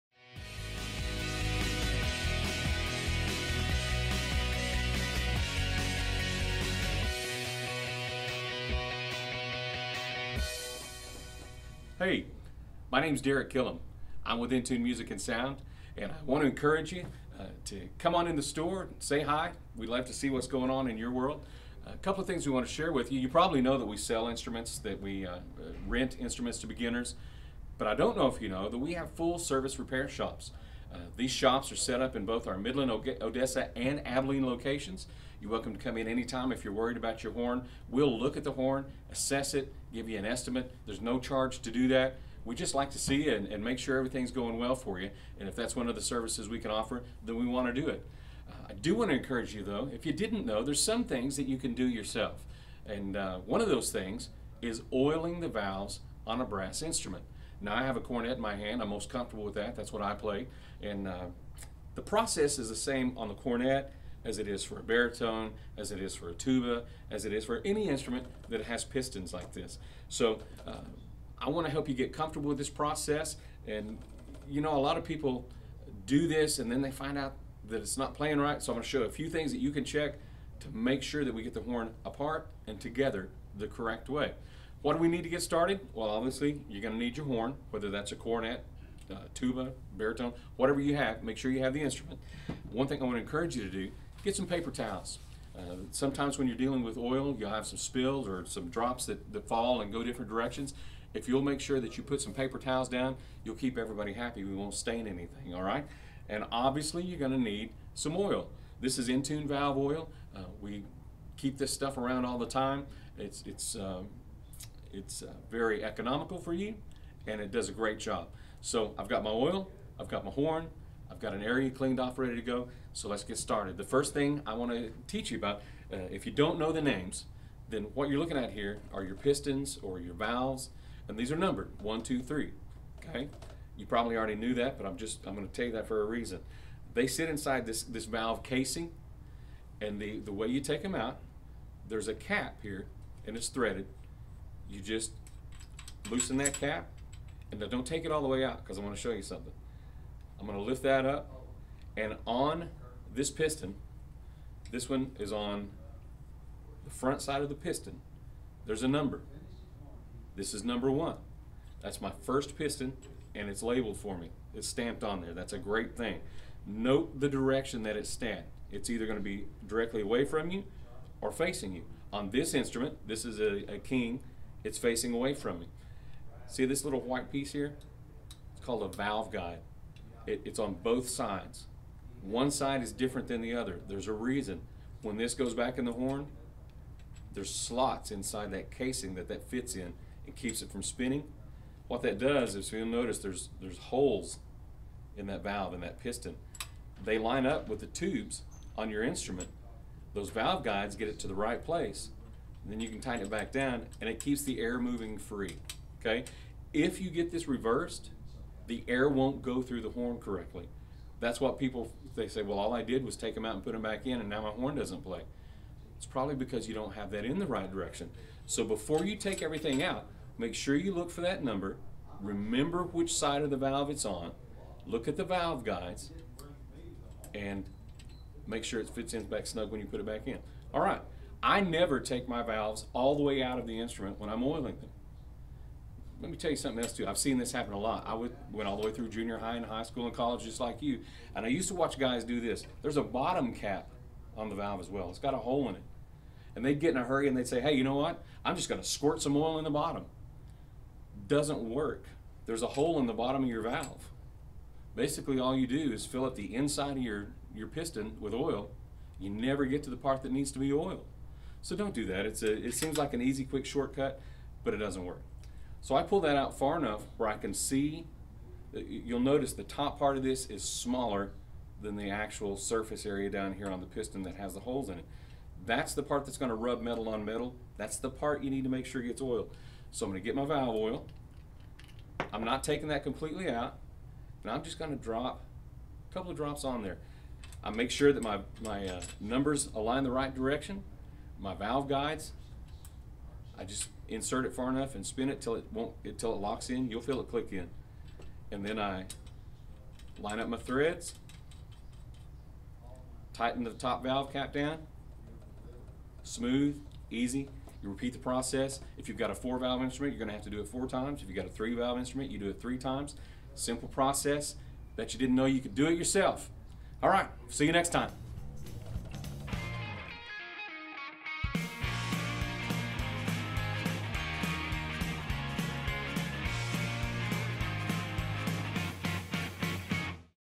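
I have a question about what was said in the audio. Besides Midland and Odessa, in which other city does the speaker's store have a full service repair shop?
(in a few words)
Abilene.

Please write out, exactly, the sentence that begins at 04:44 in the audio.
And I'm just going to drop a couple of drops on there.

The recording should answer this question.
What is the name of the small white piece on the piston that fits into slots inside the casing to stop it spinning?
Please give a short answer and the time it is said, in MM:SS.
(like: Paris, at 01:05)
valve guide, at 02:58.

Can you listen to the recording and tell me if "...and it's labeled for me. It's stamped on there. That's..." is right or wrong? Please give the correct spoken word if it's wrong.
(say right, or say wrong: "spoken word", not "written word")
right.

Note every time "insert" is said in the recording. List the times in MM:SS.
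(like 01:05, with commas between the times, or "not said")
04:54.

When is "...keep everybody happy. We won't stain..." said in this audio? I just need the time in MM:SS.
01:43.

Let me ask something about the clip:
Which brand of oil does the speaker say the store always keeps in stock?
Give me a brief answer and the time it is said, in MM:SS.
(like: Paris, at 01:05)
N-Tune valve oil, at 01:49.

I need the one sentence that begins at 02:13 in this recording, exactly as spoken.
You probably already knew that, but I'm just, I'm gonna tell you that for a reason.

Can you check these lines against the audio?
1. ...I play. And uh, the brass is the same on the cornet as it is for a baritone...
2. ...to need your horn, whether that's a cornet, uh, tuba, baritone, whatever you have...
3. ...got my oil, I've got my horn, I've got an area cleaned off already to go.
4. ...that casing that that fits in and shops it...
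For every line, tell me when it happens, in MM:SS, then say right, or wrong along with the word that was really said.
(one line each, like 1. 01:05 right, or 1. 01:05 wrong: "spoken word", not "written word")
1. 01:00 wrong: "process", not "brass"
2. 01:26 right
3. 01:59 wrong: "ready", not "already"
4. 03:08 wrong: "keeps", not "shops".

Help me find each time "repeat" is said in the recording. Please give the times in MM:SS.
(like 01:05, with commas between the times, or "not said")
05:07.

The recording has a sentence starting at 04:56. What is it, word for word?
You'll feel it click in, and then I line up my threads, tighten the top valve cap down, smooth, easy.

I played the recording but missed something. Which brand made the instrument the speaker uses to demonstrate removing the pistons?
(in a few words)
King.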